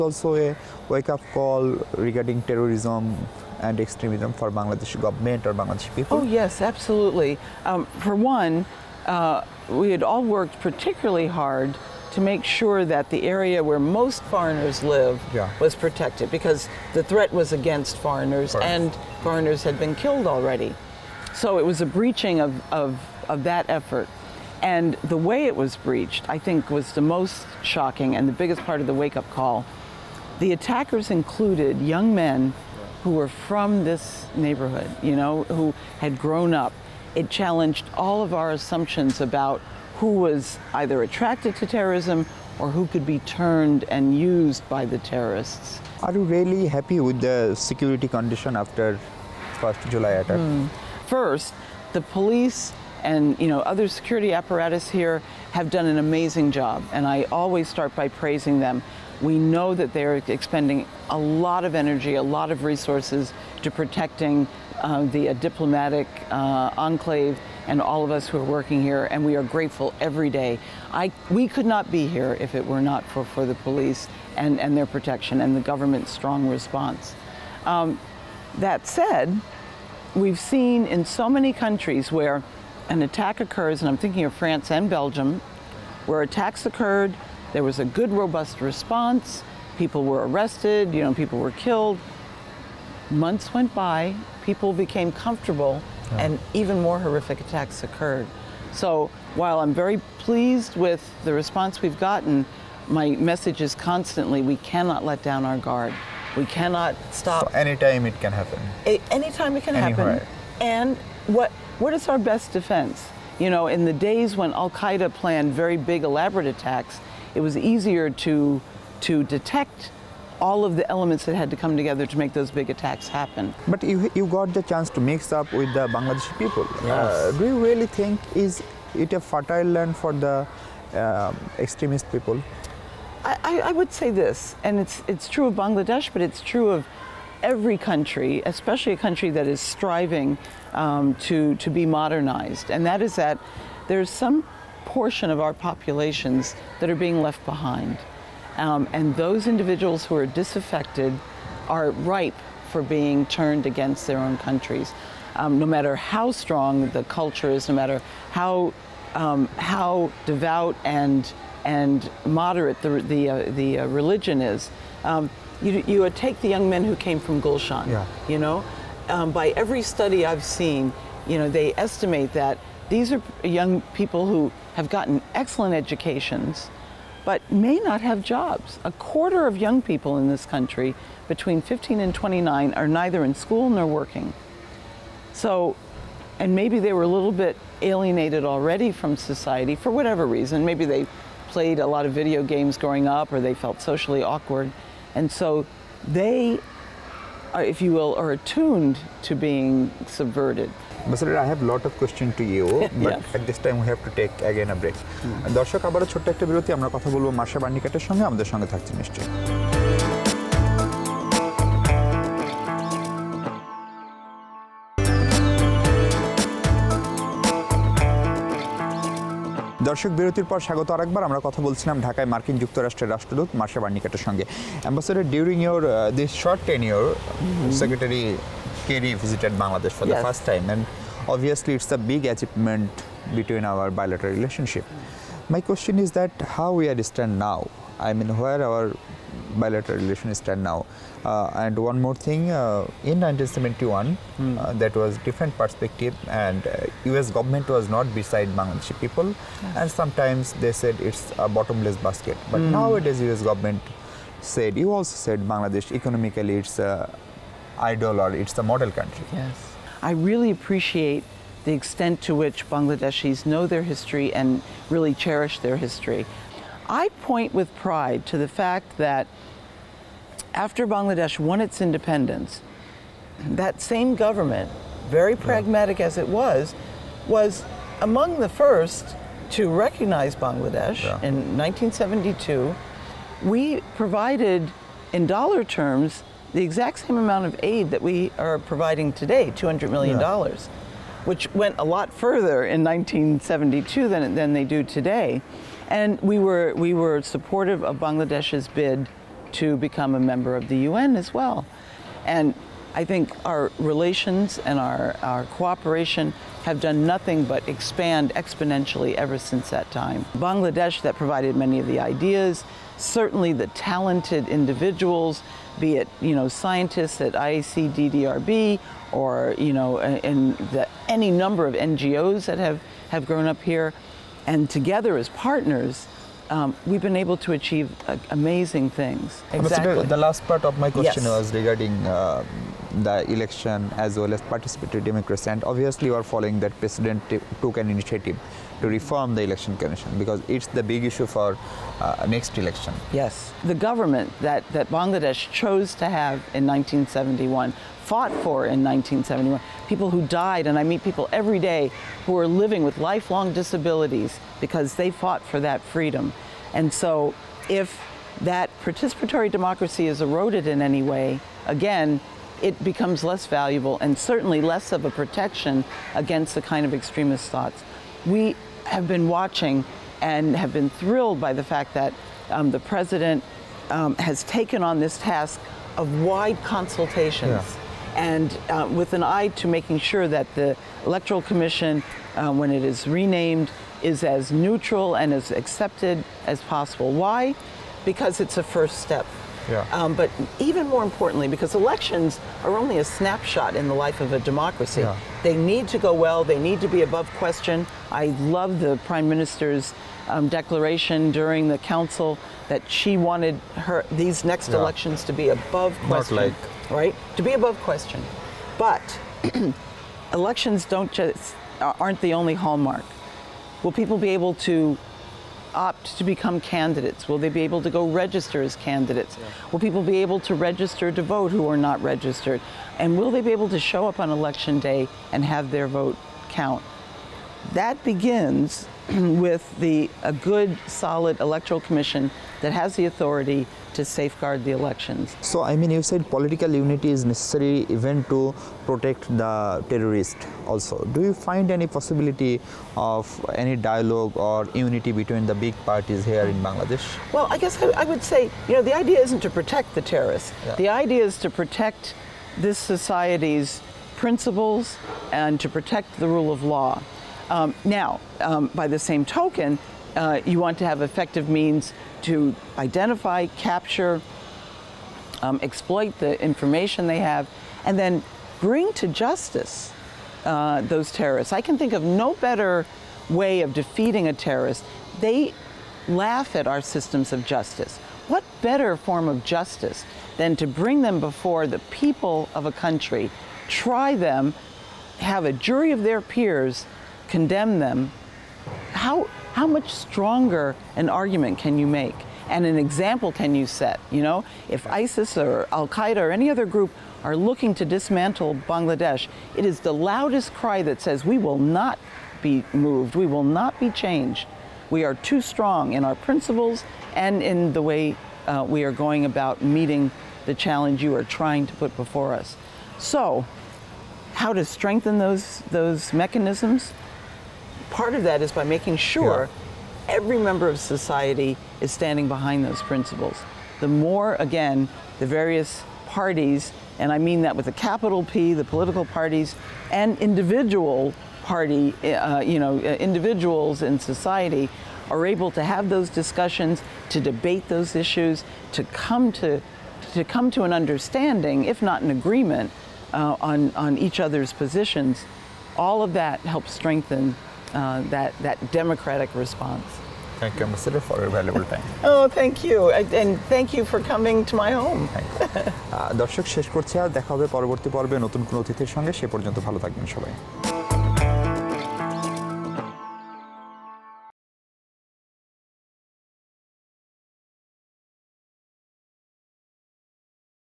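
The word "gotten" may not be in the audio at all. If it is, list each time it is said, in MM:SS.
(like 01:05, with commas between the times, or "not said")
01:41, 02:54.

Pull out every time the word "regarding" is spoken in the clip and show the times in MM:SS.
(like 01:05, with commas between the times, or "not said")
00:02, 05:31.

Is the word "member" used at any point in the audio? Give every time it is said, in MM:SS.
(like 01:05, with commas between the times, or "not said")
05:00, 08:40.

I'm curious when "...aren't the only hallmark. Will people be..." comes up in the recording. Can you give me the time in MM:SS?
06:51.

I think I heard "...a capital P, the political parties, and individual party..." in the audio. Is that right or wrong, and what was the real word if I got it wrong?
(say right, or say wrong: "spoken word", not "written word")
right.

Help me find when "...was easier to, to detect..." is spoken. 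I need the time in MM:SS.
01:57.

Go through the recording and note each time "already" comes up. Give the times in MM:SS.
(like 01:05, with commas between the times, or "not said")
00:20, 03:08.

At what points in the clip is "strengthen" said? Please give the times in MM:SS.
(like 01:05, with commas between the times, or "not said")
08:34, 09:06.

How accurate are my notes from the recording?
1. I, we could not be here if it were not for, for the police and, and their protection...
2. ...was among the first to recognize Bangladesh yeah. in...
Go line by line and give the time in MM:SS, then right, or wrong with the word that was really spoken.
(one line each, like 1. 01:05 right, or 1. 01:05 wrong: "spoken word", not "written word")
1. 01:10 right
2. 04:37 right.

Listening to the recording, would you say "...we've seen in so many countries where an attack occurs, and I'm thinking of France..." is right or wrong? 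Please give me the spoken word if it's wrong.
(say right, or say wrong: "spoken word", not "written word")
right.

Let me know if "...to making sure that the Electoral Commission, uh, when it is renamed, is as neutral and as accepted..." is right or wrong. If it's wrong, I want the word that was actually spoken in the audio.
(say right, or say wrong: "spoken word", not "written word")
right.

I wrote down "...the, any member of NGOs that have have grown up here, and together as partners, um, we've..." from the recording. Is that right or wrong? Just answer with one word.
wrong.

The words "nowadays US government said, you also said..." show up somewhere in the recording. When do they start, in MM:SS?
04:12.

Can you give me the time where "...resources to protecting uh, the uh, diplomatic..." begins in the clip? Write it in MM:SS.
01:02.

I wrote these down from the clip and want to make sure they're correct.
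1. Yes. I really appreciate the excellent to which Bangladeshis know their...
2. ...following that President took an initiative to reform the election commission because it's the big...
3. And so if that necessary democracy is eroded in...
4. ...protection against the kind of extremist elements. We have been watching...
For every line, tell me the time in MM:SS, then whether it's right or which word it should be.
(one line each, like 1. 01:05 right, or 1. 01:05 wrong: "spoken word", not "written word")
1. 04:19 wrong: "extent", not "excellent"
2. 05:36 right
3. 05:56 wrong: "participatory", not "necessary"
4. 06:05 wrong: "thoughts", not "elements".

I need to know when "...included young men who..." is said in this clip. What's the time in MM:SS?
00:31.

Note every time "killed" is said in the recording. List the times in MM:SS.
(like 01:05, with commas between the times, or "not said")
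00:19, 01:31.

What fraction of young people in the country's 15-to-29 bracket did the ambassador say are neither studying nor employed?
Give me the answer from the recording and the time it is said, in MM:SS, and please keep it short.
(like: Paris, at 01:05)
A quarter, at 02:58.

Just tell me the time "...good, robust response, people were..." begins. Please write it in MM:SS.
01:27.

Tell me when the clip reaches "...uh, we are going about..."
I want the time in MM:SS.
08:28.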